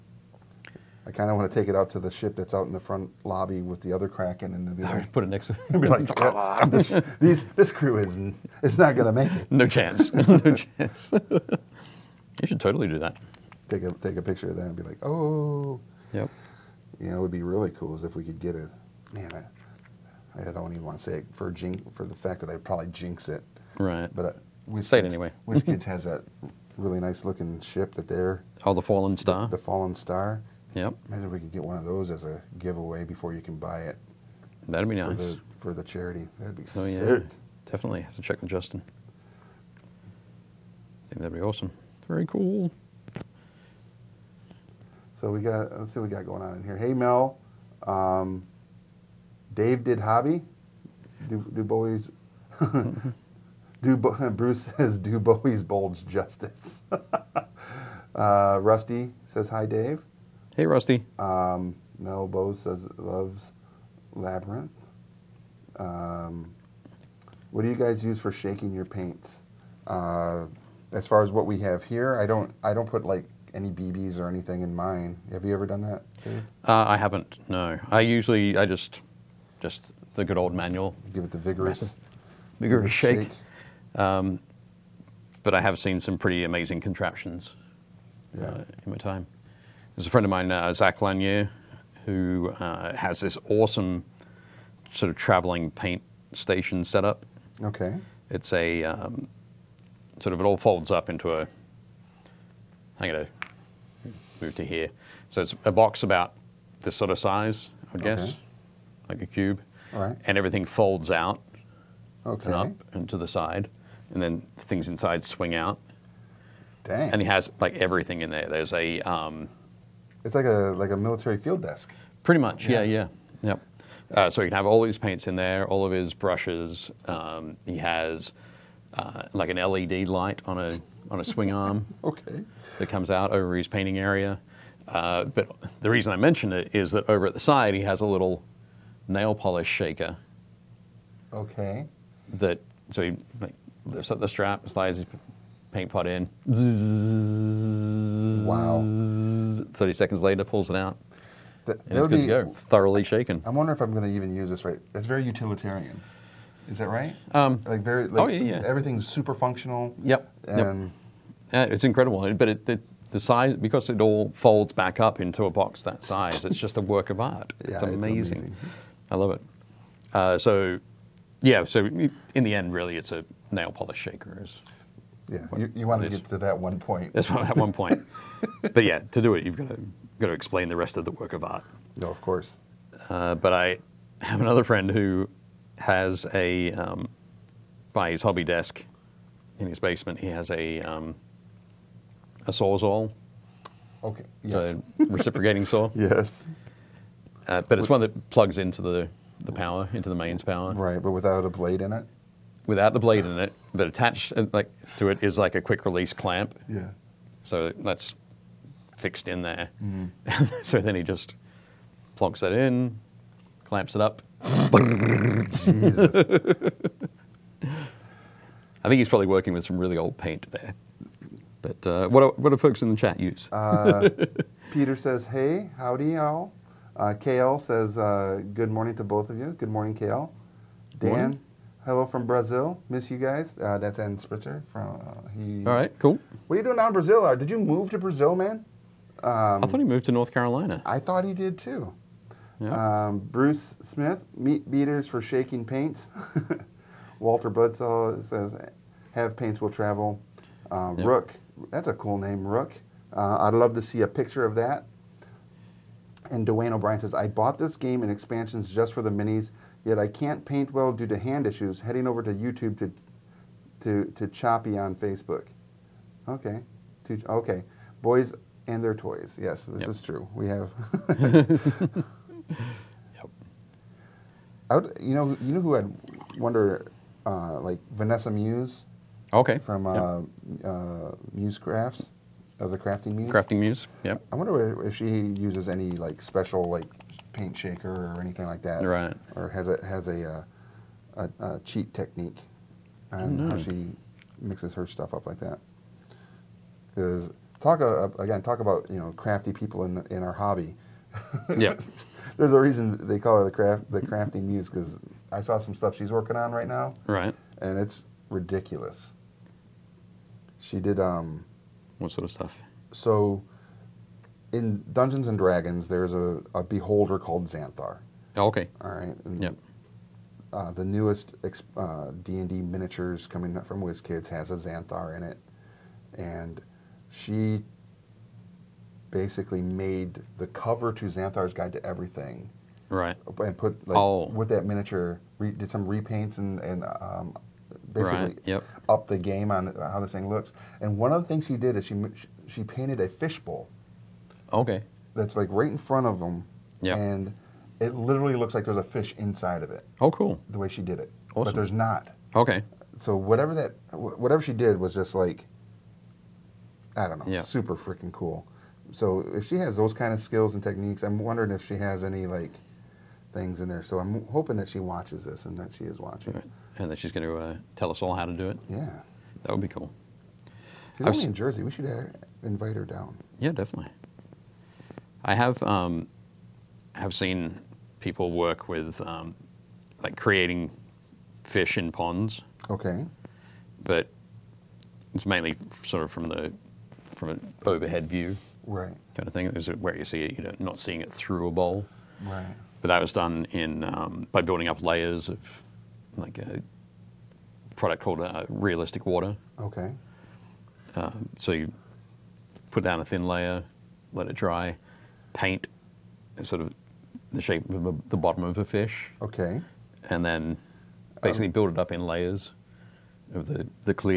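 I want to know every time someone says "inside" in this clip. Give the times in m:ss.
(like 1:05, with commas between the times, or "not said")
1:54, 5:49.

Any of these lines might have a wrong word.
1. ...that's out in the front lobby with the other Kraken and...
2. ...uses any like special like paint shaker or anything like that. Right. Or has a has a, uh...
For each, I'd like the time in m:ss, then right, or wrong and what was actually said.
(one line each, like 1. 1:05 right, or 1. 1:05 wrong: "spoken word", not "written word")
1. 0:02 right
2. 4:45 right.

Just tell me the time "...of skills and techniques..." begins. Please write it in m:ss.
6:00.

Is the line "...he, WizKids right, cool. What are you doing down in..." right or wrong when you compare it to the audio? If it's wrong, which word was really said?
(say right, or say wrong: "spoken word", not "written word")
wrong: "All", not "WizKids".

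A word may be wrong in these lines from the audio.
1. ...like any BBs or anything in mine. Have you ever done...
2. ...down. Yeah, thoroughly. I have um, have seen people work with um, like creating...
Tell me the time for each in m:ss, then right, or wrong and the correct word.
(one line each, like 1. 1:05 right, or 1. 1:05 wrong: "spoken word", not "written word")
1. 1:13 right
2. 6:12 wrong: "definitely", not "thoroughly".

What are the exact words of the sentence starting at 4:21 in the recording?
Heading over to YouTube to to to choppy on Facebook.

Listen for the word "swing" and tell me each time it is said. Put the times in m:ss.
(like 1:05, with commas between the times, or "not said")
1:55, 2:11.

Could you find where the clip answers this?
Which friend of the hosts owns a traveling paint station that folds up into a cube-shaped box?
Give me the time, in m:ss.
1:30.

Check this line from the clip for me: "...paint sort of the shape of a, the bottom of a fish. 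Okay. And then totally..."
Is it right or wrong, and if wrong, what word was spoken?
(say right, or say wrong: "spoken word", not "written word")
wrong: "basically", not "totally".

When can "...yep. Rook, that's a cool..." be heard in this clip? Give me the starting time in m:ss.
4:10.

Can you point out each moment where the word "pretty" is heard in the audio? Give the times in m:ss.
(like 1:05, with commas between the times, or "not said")
1:26, 2:02.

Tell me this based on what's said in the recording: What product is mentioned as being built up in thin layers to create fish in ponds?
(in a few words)
Realistic water.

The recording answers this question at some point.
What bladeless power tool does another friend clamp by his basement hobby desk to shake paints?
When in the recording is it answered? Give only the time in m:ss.
3:12.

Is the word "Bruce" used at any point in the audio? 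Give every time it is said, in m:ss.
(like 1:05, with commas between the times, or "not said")
0:54, 4:03.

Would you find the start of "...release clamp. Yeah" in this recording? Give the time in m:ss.
3:25.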